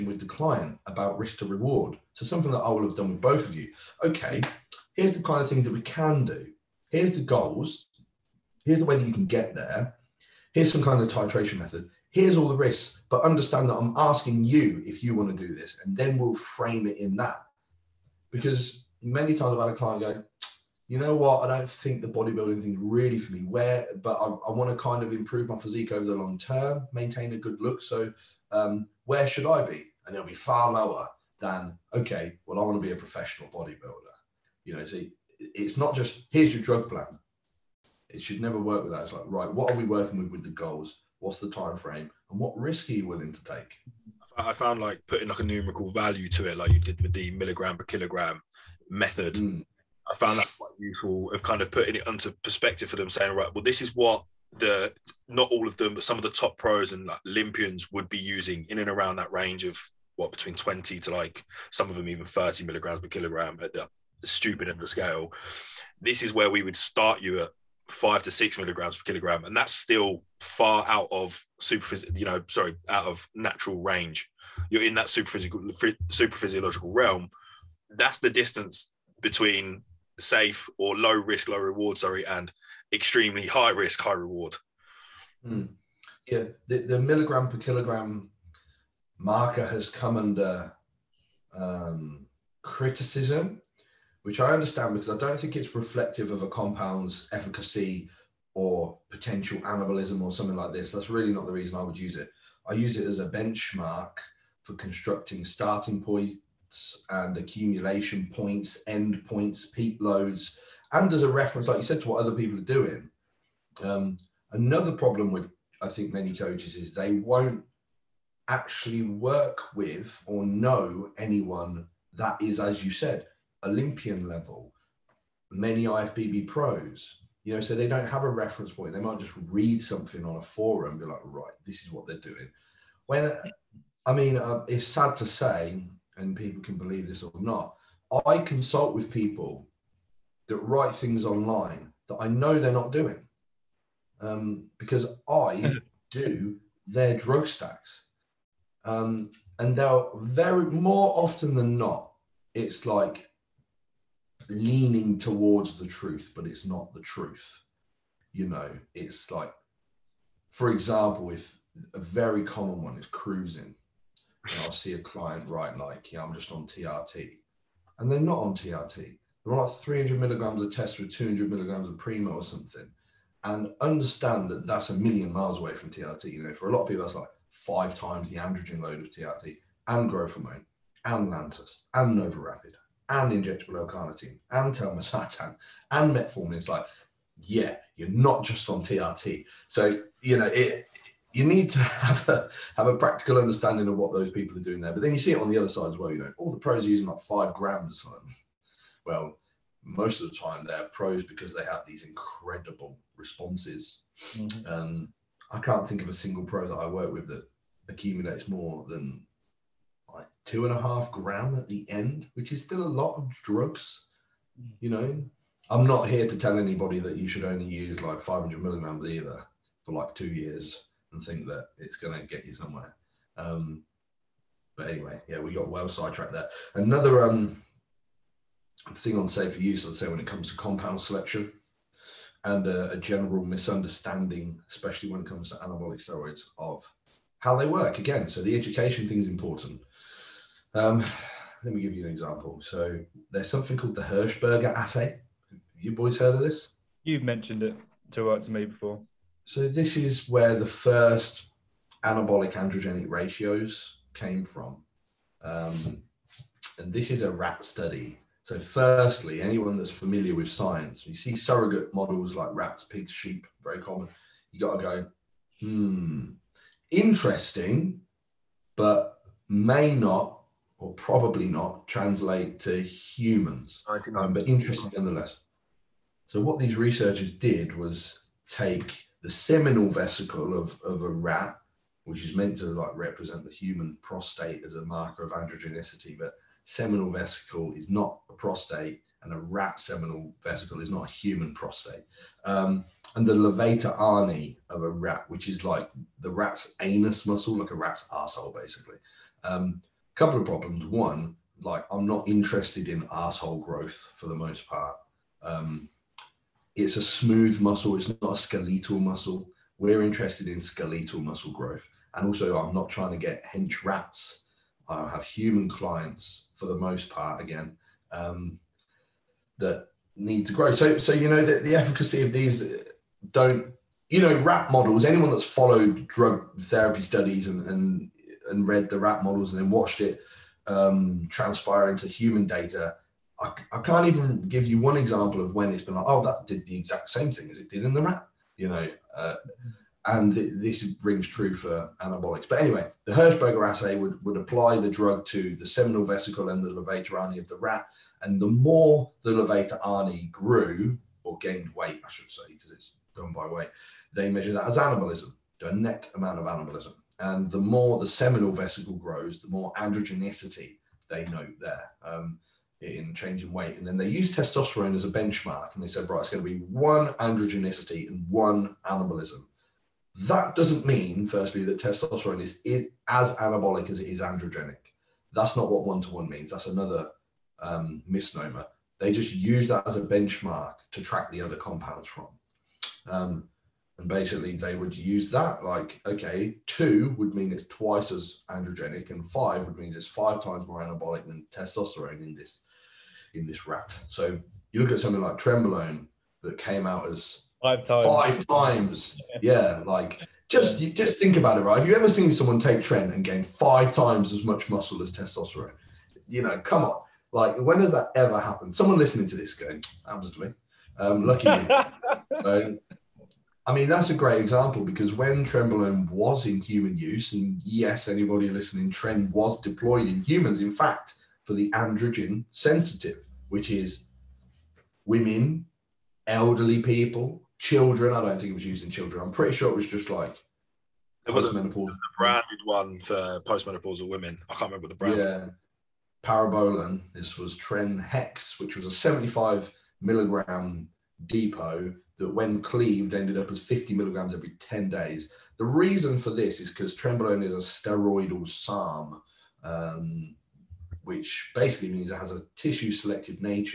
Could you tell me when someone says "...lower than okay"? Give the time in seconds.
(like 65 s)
30 s.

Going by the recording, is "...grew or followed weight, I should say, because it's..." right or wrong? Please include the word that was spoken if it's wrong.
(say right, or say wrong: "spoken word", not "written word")
wrong: "gained", not "followed".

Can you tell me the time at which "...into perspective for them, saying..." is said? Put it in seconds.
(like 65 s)
52 s.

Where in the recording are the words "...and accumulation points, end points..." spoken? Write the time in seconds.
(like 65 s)
107 s.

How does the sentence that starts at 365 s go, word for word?
And they said, right, it's going to be one androgenicity and one anabolism.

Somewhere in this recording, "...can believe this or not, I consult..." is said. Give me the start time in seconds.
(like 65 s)
136 s.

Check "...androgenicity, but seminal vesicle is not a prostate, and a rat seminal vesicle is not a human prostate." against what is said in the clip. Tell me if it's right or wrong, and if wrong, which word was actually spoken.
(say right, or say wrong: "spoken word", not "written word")
right.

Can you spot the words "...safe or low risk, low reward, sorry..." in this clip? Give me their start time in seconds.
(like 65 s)
80 s.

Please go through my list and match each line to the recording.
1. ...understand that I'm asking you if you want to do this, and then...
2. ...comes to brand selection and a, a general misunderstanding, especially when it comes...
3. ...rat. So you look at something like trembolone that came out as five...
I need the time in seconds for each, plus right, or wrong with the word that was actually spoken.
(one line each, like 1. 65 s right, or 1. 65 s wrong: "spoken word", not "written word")
1. 13 s right
2. 230 s wrong: "compound", not "brand"
3. 393 s right.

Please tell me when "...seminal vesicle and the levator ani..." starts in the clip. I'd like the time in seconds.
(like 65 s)
345 s.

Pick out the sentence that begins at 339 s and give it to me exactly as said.
Uh, and th- this rings true for anabolics.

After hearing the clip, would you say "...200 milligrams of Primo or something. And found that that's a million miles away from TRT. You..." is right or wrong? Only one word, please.
wrong.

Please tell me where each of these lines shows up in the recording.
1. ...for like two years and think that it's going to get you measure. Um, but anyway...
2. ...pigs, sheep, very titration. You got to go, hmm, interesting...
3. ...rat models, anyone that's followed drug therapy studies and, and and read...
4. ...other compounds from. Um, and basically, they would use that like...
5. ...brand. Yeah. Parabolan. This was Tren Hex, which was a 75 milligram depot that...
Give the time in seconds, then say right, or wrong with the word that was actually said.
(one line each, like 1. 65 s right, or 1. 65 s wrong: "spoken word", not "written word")
1. 219 s wrong: "somewhere", not "measure"
2. 262 s wrong: "common", not "titration"
3. 324 s right
4. 381 s right
5. 434 s right.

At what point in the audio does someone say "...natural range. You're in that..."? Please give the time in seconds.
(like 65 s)
73 s.